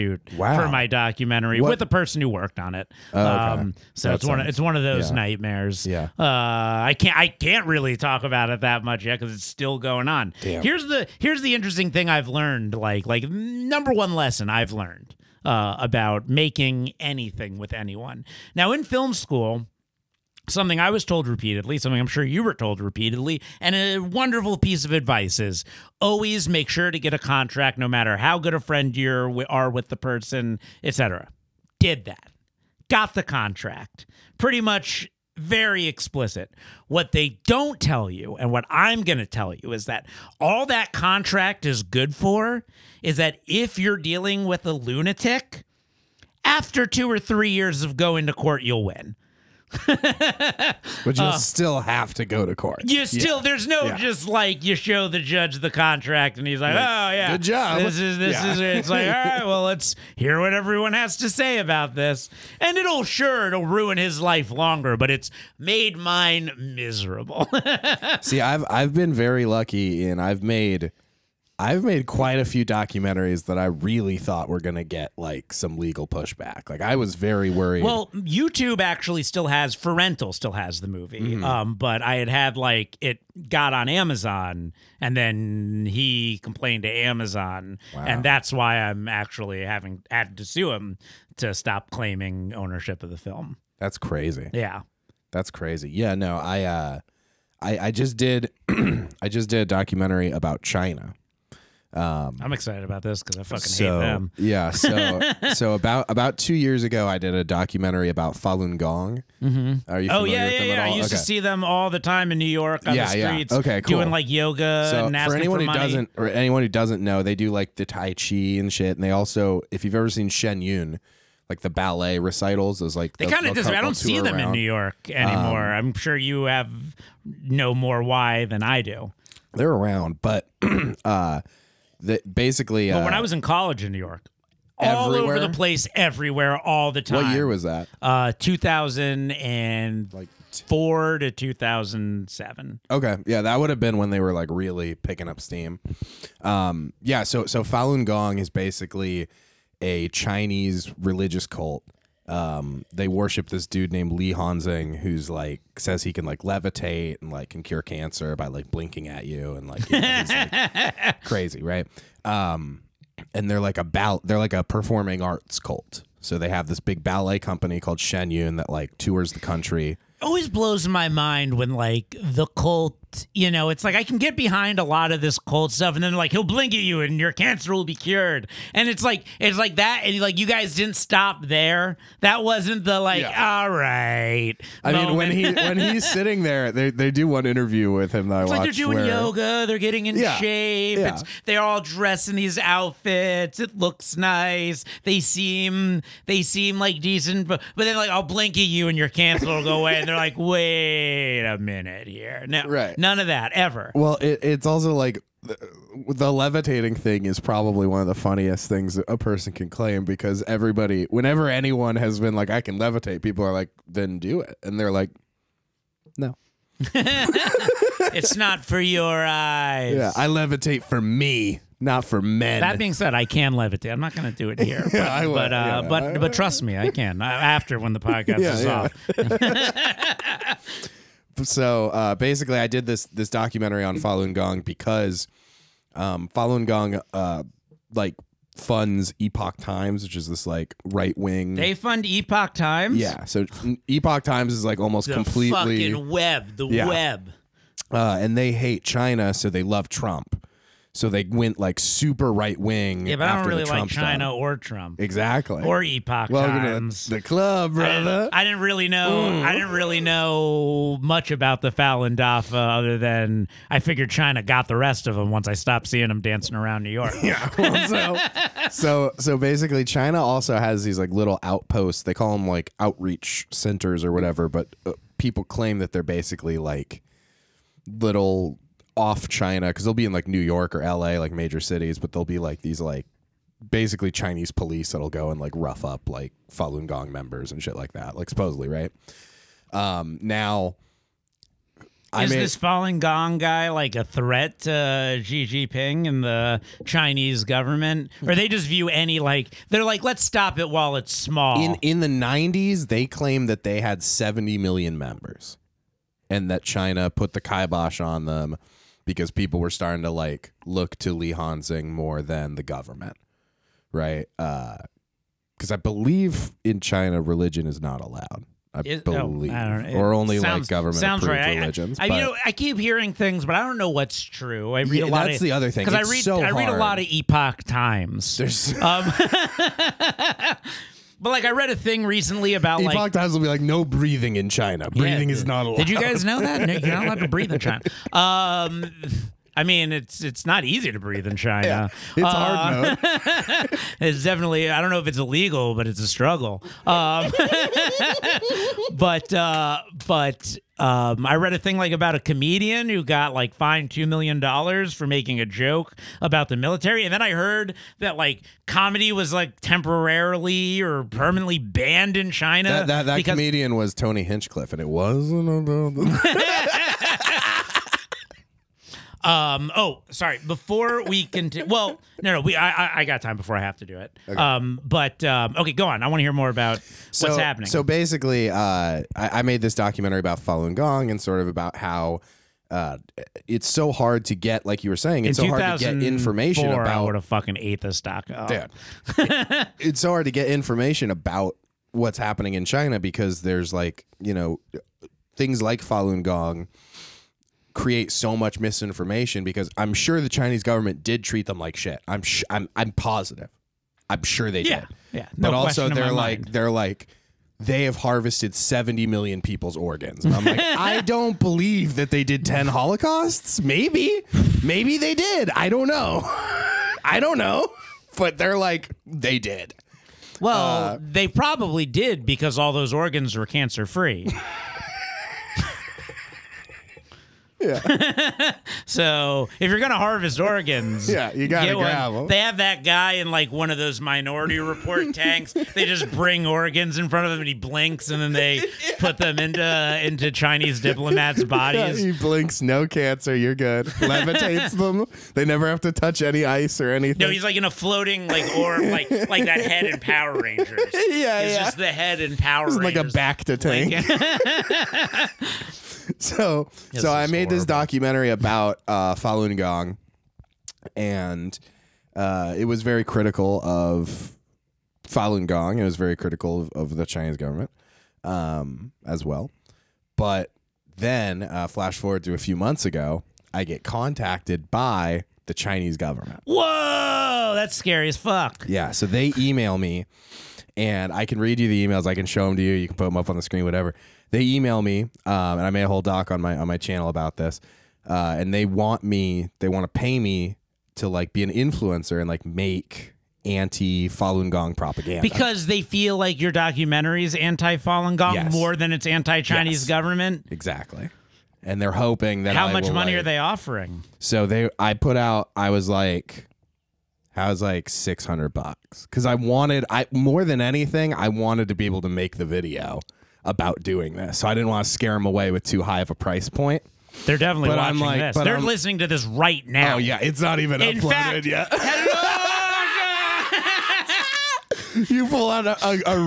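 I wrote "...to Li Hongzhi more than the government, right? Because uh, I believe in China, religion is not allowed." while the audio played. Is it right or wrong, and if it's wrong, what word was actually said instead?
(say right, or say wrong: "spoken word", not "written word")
right.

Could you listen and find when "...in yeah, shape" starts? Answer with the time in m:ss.
3:10.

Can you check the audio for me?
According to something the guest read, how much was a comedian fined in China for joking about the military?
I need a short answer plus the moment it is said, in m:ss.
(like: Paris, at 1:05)
2 million dollars, at 5:53.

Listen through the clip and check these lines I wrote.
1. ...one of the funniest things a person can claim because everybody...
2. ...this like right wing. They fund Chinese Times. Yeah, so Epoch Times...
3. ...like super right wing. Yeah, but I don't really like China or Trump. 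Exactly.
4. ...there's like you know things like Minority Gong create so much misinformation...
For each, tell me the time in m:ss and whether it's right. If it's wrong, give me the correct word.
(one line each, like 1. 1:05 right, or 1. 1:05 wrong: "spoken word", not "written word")
1. 3:27 right
2. 4:00 wrong: "Epoch", not "Chinese"
3. 4:11 right
4. 6:33 wrong: "Falun", not "Minority".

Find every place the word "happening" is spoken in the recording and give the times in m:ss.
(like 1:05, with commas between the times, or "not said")
6:17, 6:32.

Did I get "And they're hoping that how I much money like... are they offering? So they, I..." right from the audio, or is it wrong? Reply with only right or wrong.
right.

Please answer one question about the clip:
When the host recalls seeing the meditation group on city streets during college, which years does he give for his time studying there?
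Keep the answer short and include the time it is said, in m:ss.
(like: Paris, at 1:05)
2004 to 2007, at 2:18.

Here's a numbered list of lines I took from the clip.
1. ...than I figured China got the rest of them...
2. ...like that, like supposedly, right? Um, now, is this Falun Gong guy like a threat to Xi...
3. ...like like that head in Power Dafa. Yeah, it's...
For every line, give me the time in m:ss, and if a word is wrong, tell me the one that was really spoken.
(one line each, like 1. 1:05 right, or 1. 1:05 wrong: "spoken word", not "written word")
1. 4:22 right
2. 4:47 right
3. 7:28 wrong: "Rangers", not "Dafa".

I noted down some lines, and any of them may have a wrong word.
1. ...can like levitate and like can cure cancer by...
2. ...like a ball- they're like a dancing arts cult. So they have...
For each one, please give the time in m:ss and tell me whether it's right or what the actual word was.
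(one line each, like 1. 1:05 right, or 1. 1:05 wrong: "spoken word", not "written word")
1. 2:36 right
2. 2:43 wrong: "performing", not "dancing".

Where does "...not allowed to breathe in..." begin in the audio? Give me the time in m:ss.
5:36.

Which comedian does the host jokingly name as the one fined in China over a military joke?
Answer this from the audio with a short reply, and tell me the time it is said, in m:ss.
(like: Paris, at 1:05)
Tony Hinchcliffe, at 6:03.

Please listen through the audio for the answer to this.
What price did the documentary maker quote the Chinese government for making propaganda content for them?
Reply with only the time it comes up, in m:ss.
8:27.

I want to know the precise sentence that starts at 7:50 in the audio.
But then, uh, flash forward to a few months ago, I get contacted by the Chinese government.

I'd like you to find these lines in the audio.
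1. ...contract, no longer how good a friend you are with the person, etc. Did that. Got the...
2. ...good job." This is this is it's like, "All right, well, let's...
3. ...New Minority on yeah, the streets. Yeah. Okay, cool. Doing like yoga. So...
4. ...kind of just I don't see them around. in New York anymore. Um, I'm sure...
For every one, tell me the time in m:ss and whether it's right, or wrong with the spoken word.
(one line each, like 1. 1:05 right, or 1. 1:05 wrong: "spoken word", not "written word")
1. 0:27 wrong: "matter", not "longer"
2. 0:57 right
3. 1:52 wrong: "York", not "Minority"
4. 2:03 right.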